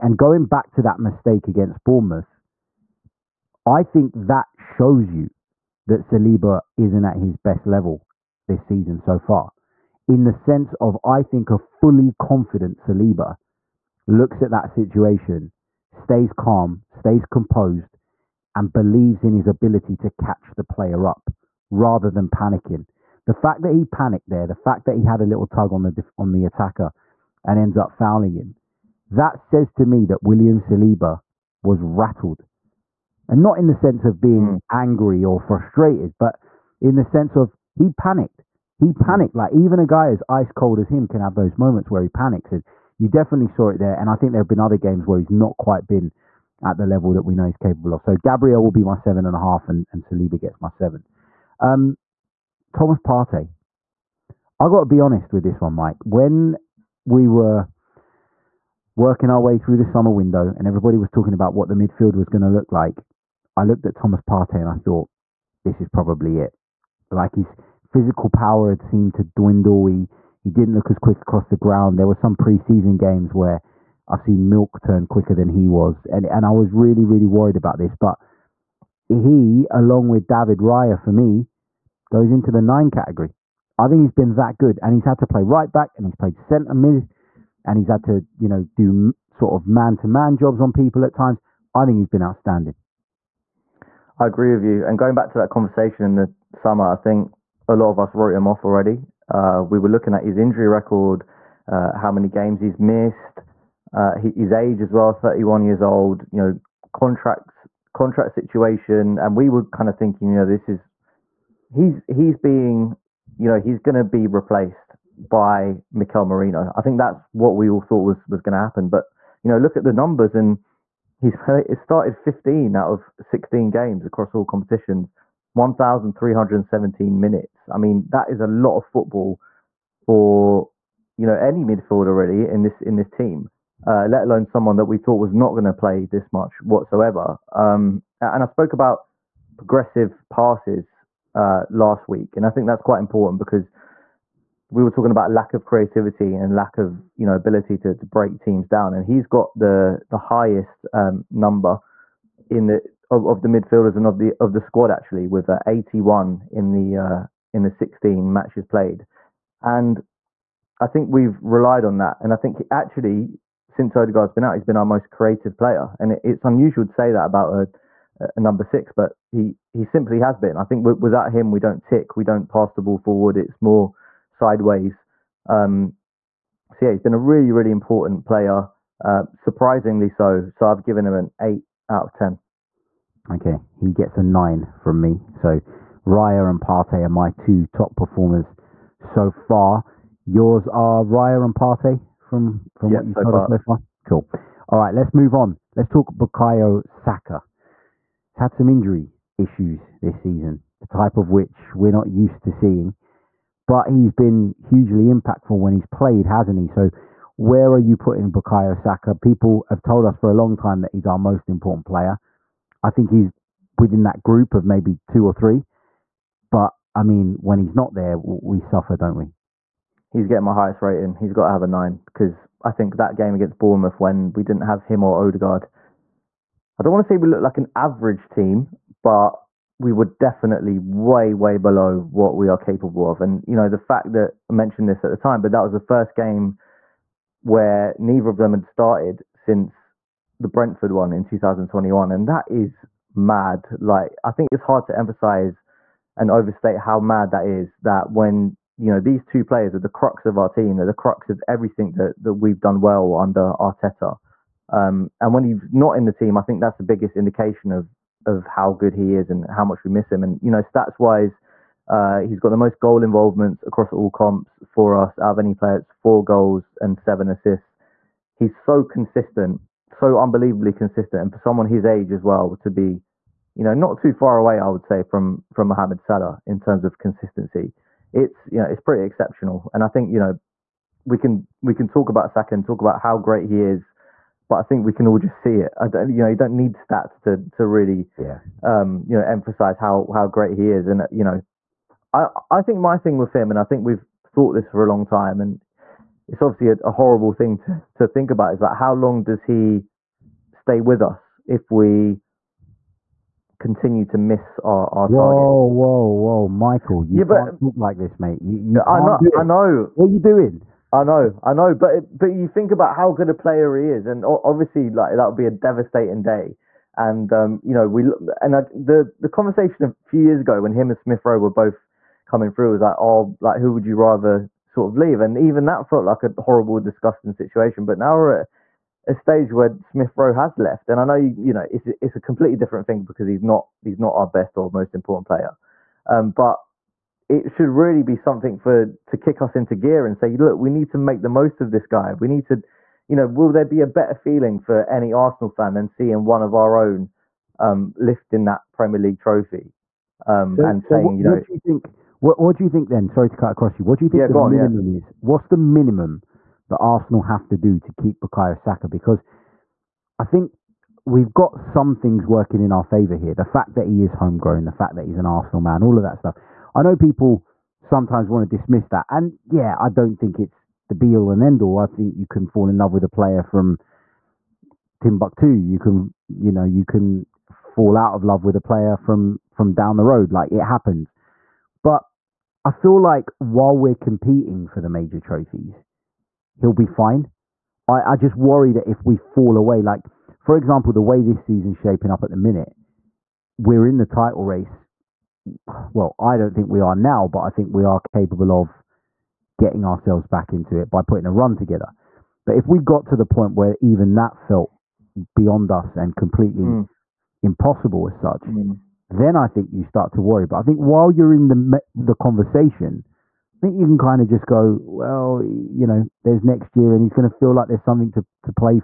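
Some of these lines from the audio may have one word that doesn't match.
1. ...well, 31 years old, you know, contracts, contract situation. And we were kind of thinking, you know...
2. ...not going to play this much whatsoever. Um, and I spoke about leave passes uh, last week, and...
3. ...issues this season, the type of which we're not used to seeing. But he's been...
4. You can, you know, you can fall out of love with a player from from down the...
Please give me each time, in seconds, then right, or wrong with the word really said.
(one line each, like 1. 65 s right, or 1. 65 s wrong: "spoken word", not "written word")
1. 104 s right
2. 135 s wrong: "progressive", not "leave"
3. 199 s right
4. 375 s right.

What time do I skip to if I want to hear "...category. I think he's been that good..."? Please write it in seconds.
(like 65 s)
82 s.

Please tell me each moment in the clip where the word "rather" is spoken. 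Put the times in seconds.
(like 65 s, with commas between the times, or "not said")
21 s, 323 s.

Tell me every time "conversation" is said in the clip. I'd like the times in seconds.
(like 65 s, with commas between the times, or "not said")
95 s, 319 s, 412 s.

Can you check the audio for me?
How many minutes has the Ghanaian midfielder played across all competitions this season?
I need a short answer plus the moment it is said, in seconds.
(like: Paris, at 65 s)
1,317, at 125 s.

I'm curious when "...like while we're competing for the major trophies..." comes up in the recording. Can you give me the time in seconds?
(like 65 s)
382 s.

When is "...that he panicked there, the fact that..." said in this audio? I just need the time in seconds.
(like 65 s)
23 s.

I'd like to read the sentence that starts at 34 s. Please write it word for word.
angry or frustrated, but in the sense of he panicked.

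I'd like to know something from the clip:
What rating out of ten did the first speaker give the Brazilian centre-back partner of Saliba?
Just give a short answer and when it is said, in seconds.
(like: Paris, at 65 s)
7.5, at 48 s.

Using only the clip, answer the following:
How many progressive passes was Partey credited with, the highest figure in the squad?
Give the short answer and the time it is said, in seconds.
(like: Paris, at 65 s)
81, at 155 s.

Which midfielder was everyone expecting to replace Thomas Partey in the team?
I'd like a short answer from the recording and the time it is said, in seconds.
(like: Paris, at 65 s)
Mikel Merino, at 115 s.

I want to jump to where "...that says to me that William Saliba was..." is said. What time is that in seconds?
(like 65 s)
29 s.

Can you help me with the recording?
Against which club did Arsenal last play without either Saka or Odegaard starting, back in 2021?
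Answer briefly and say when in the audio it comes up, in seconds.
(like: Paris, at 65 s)
Brentford, at 240 s.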